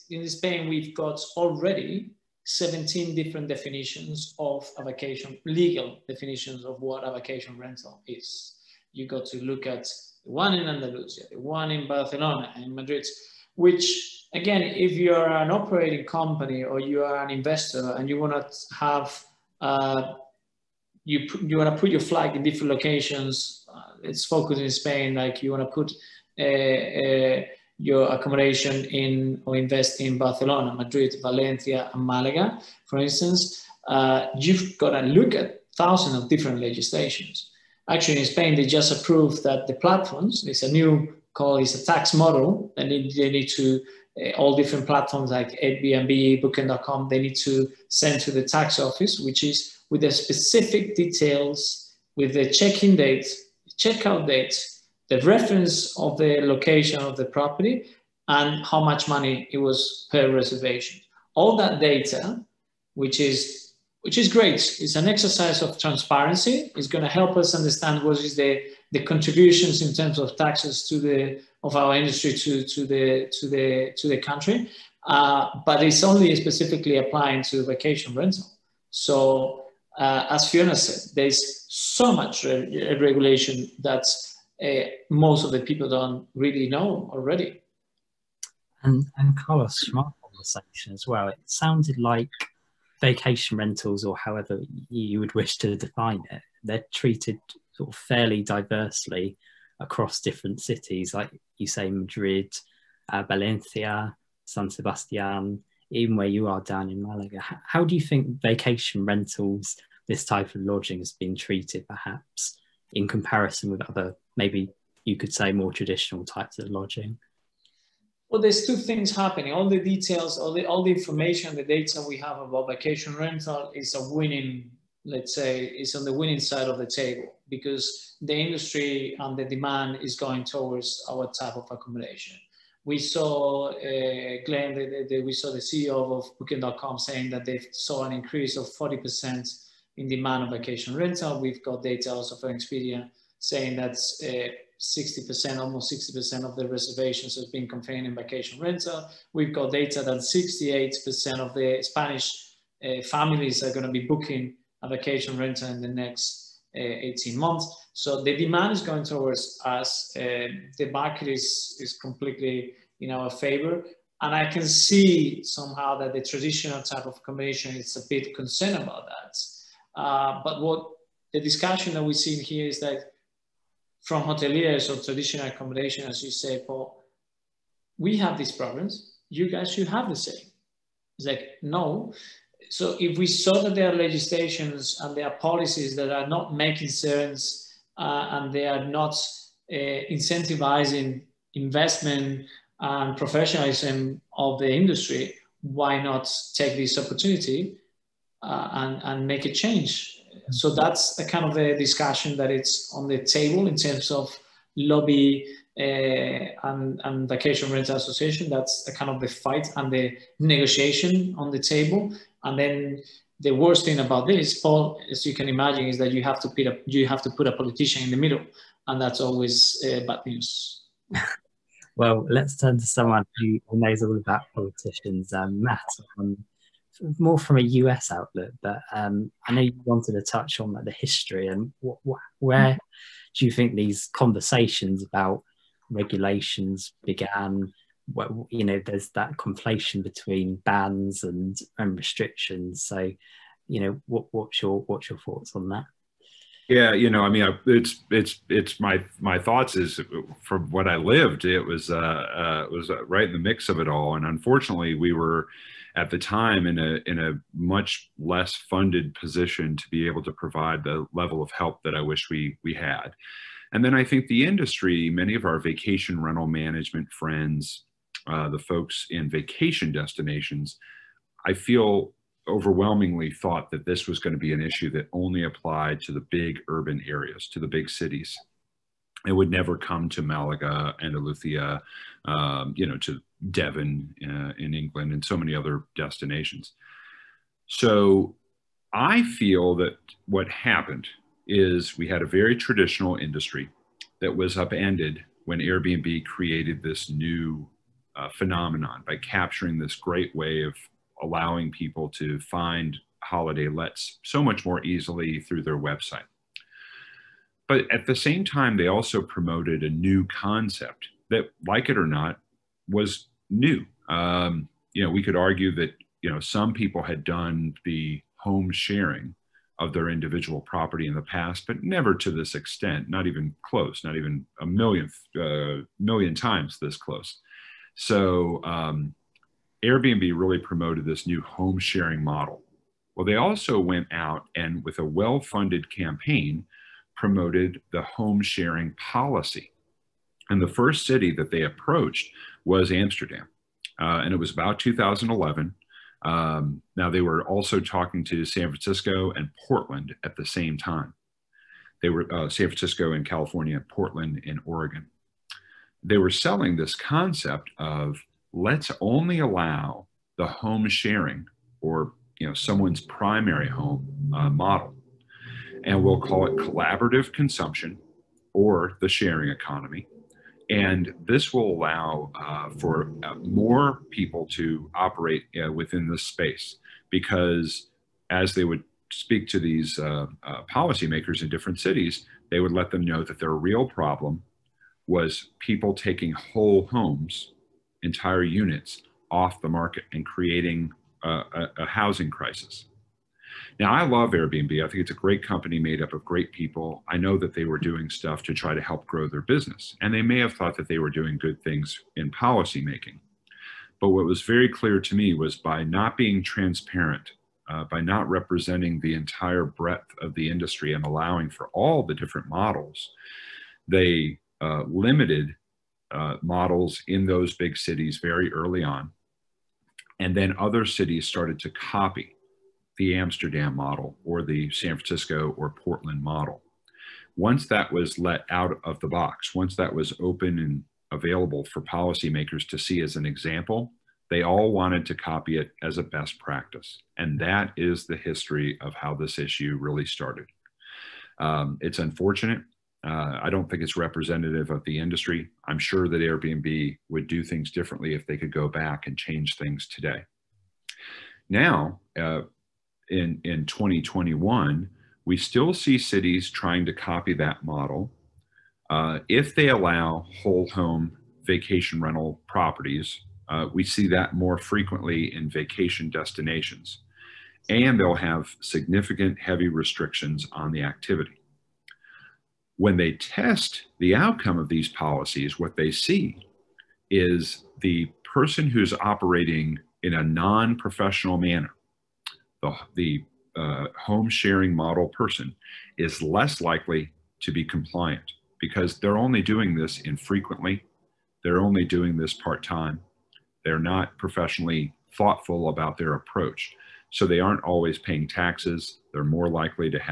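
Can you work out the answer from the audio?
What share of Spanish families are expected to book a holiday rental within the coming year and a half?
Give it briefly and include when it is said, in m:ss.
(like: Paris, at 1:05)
68%, at 2:30.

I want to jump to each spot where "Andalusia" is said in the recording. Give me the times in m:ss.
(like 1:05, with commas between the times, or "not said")
0:10, 4:41.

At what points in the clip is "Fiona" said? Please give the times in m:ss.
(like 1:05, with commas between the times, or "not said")
1:20.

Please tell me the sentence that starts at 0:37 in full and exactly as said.
Actually, in Spain, they just approved that the platforms, it's a new call is a tax model.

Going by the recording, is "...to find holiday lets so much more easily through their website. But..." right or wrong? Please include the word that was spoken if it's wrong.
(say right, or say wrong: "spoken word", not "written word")
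right.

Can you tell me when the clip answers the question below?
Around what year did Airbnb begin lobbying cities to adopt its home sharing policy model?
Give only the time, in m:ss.
5:44.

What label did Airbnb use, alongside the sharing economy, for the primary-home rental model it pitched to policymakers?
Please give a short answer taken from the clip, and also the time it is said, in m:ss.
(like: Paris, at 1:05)
collaborative consumption, at 6:06.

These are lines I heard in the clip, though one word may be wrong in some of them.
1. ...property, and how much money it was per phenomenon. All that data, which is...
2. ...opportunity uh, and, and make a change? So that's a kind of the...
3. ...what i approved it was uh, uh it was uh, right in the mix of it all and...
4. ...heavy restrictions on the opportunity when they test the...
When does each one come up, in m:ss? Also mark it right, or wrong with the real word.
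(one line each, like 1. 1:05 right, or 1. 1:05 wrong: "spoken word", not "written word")
1. 0:57 wrong: "reservation", not "phenomenon"
2. 3:16 right
3. 4:10 wrong: "lived", not "approved"
4. 7:49 wrong: "activity", not "opportunity".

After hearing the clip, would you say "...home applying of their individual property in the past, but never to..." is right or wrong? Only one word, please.
wrong.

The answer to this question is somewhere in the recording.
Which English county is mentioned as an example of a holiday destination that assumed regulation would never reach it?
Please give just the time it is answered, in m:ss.
4:43.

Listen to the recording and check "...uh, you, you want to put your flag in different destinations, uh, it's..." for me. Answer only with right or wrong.
wrong.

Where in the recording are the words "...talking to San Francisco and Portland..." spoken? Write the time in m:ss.
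5:47.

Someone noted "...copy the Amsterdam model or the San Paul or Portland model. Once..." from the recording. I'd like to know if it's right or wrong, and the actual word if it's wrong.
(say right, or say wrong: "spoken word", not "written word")
wrong: "Francisco", not "Paul".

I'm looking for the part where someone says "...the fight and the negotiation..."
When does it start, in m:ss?
3:29.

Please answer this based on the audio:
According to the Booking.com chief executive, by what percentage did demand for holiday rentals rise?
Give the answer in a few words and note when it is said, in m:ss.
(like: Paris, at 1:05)
40%, at 2:18.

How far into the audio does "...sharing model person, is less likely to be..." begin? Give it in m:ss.
8:04.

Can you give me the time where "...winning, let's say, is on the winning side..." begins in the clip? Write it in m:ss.
2:04.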